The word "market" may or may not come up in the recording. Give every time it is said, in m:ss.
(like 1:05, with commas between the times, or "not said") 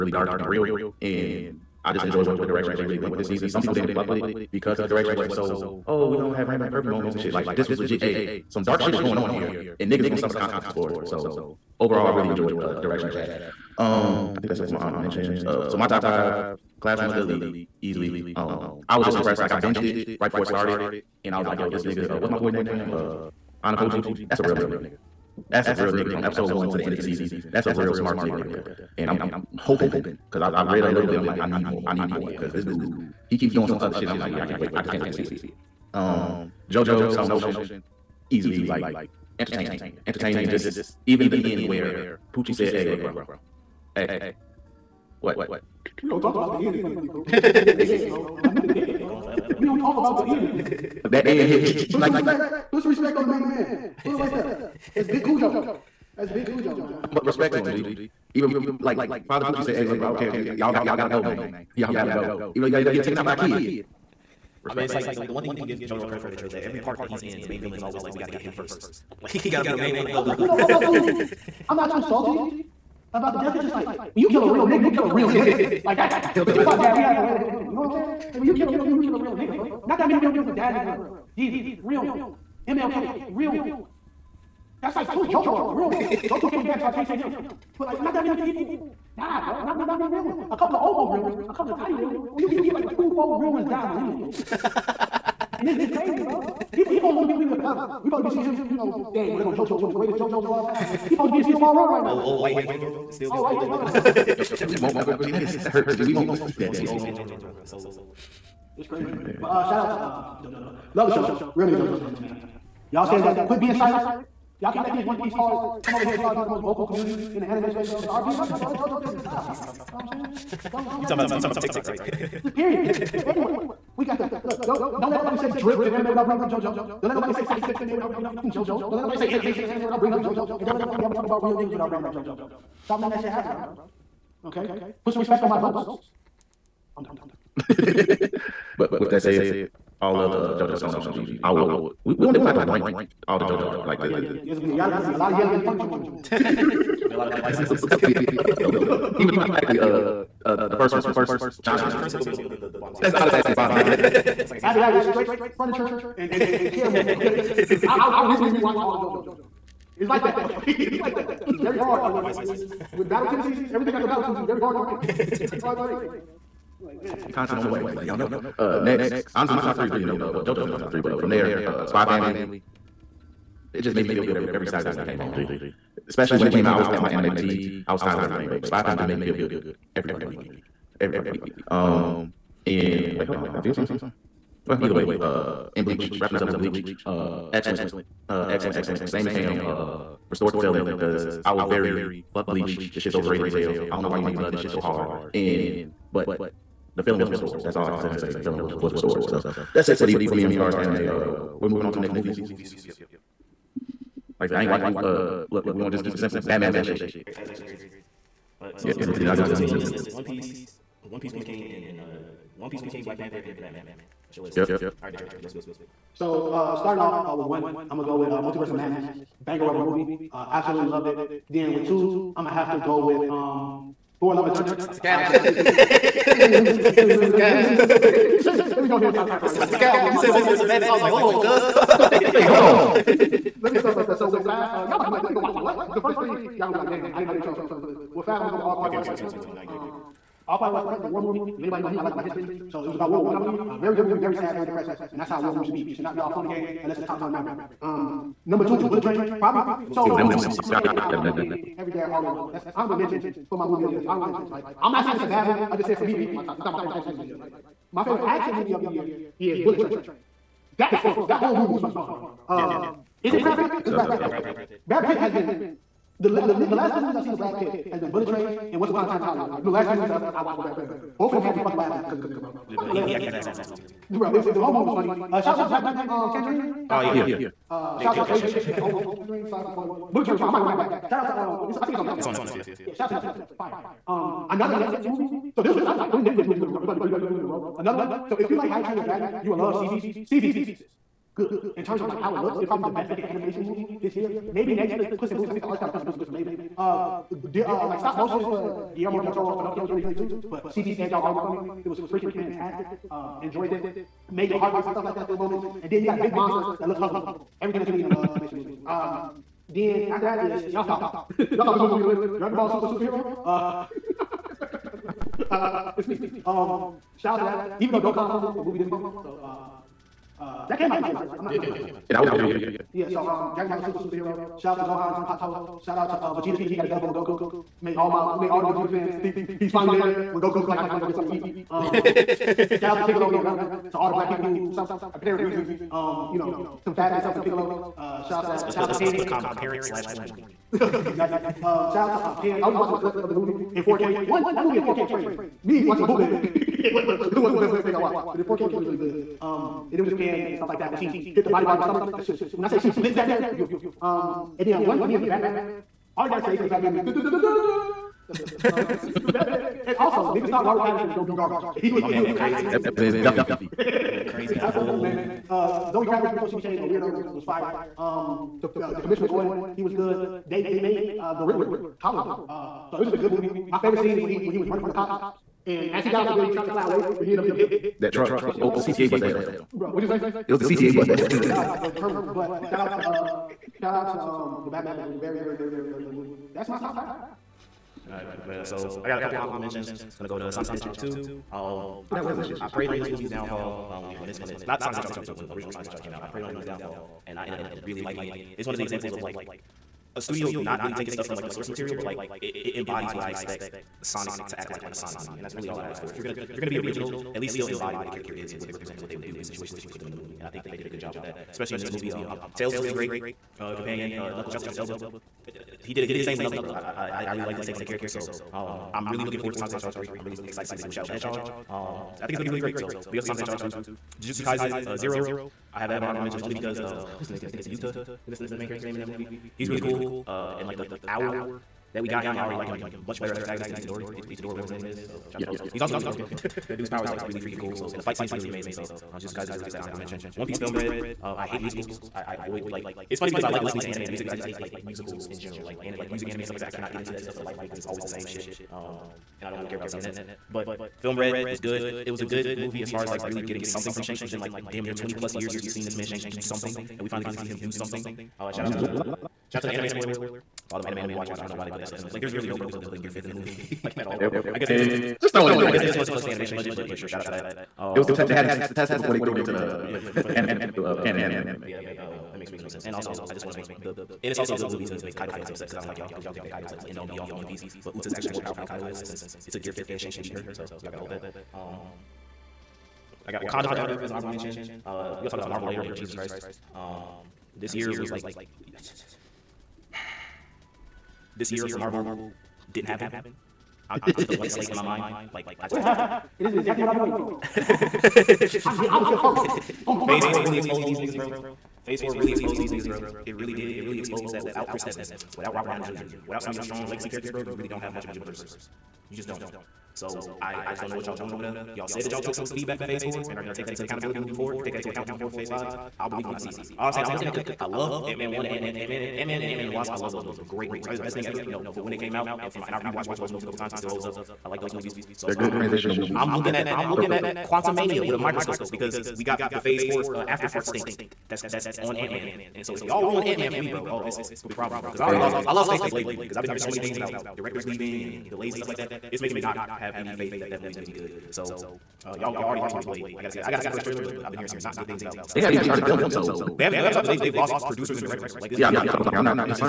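not said.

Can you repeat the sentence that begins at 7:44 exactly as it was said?
But I guess they just eh, just throw it in there.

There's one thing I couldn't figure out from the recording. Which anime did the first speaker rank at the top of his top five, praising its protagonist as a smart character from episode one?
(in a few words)
Classroom of the Elite.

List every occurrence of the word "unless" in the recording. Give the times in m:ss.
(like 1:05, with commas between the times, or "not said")
4:06.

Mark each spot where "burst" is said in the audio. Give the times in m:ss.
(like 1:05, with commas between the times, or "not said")
not said.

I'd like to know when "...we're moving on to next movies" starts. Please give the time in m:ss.
3:21.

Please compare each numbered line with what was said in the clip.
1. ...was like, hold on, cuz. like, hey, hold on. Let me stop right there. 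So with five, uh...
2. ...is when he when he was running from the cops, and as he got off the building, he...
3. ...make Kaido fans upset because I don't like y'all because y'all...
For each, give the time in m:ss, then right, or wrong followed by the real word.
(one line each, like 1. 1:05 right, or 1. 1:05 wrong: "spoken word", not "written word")
1. 3:50 right
2. 6:14 right
3. 7:55 right.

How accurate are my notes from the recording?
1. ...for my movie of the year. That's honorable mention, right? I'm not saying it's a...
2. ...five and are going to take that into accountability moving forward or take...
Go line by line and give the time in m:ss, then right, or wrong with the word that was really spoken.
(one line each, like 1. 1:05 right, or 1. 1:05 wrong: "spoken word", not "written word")
1. 4:13 right
2. 8:33 wrong: "four", not "five".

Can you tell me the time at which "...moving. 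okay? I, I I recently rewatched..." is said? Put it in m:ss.
2:36.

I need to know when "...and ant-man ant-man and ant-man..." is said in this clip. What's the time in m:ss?
8:38.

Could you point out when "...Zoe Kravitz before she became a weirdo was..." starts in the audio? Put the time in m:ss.
6:05.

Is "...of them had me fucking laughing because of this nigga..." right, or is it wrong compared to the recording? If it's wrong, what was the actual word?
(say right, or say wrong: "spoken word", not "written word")
right.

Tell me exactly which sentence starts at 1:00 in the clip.
Y'all got y'all gotta go, man.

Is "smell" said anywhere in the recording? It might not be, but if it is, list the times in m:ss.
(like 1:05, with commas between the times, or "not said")
not said.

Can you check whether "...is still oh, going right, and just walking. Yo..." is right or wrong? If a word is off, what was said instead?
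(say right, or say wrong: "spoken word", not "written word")
right.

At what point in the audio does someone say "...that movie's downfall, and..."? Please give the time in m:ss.
6:36.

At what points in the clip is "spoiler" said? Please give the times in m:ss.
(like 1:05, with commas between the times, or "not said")
4:39, 7:39.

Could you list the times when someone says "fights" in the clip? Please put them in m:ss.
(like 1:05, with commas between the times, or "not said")
2:07, 7:18.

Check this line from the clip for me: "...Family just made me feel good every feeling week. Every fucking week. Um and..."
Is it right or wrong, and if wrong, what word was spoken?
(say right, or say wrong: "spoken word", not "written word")
wrong: "fucking", not "feeling".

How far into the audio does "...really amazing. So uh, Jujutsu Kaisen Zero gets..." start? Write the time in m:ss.
7:18.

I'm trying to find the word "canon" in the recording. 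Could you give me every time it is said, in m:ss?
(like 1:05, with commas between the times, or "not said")
7:51.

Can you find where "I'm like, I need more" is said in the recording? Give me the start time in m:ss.
0:31.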